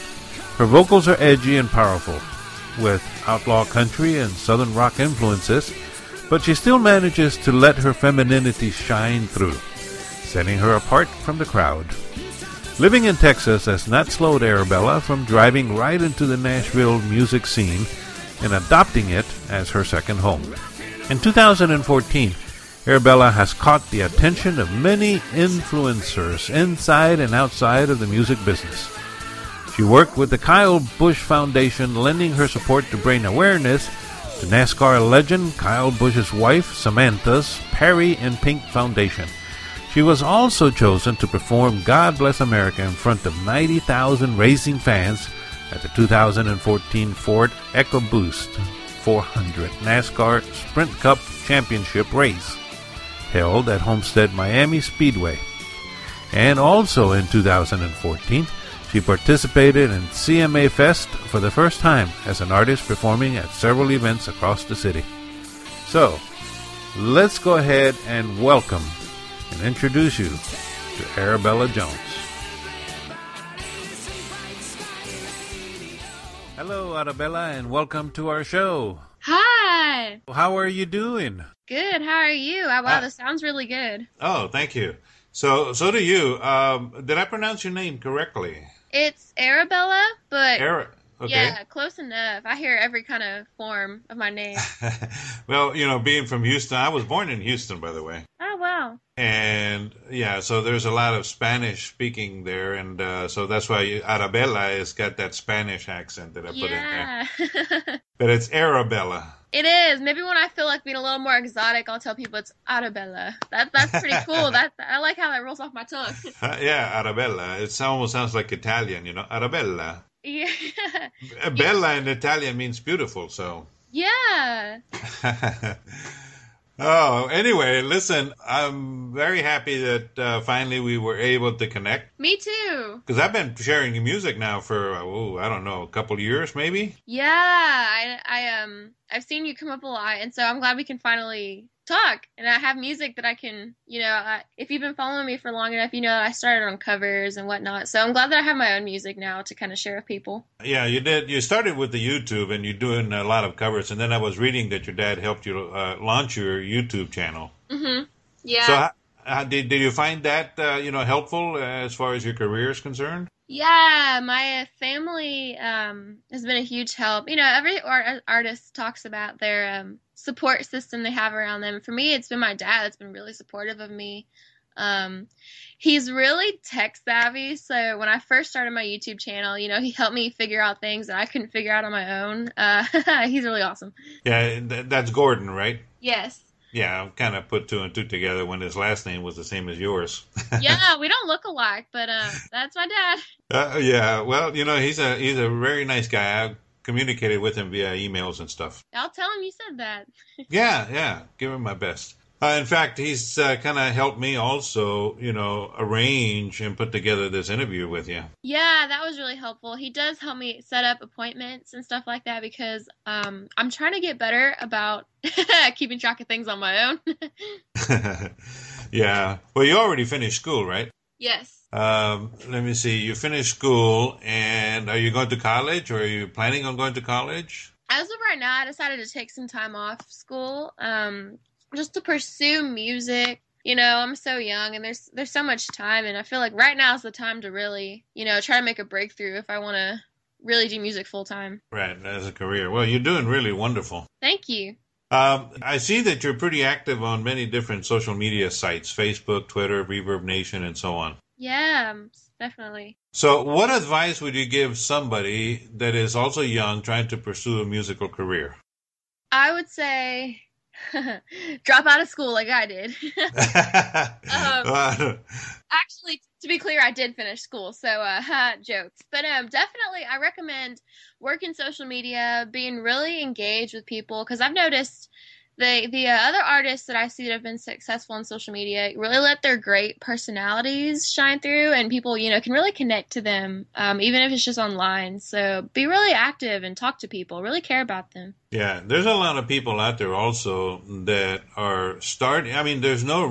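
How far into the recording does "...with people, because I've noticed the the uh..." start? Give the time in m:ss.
4:33.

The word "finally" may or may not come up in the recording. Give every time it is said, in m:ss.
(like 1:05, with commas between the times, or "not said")
2:10, 2:20.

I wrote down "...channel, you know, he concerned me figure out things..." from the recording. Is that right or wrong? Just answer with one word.
wrong.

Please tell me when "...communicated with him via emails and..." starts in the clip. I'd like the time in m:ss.
3:16.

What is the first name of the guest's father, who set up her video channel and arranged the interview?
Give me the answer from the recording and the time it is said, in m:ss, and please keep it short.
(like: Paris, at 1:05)
Gordon, at 3:05.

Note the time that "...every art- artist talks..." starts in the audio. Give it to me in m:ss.
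2:47.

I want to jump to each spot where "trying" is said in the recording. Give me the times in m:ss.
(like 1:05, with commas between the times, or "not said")
3:33, 4:16.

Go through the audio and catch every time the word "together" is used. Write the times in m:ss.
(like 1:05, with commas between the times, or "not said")
3:08, 3:26.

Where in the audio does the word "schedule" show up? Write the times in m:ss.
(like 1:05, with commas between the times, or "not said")
not said.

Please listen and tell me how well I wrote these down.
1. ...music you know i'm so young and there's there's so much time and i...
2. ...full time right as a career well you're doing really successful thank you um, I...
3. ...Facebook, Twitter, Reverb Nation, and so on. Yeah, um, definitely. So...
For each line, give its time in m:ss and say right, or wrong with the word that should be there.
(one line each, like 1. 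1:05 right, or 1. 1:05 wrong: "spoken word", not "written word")
1. 3:52 right
2. 4:01 wrong: "wonderful", not "successful"
3. 4:08 right.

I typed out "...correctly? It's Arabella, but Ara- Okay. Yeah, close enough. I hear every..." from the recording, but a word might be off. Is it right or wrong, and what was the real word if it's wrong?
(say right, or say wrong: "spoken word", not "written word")
right.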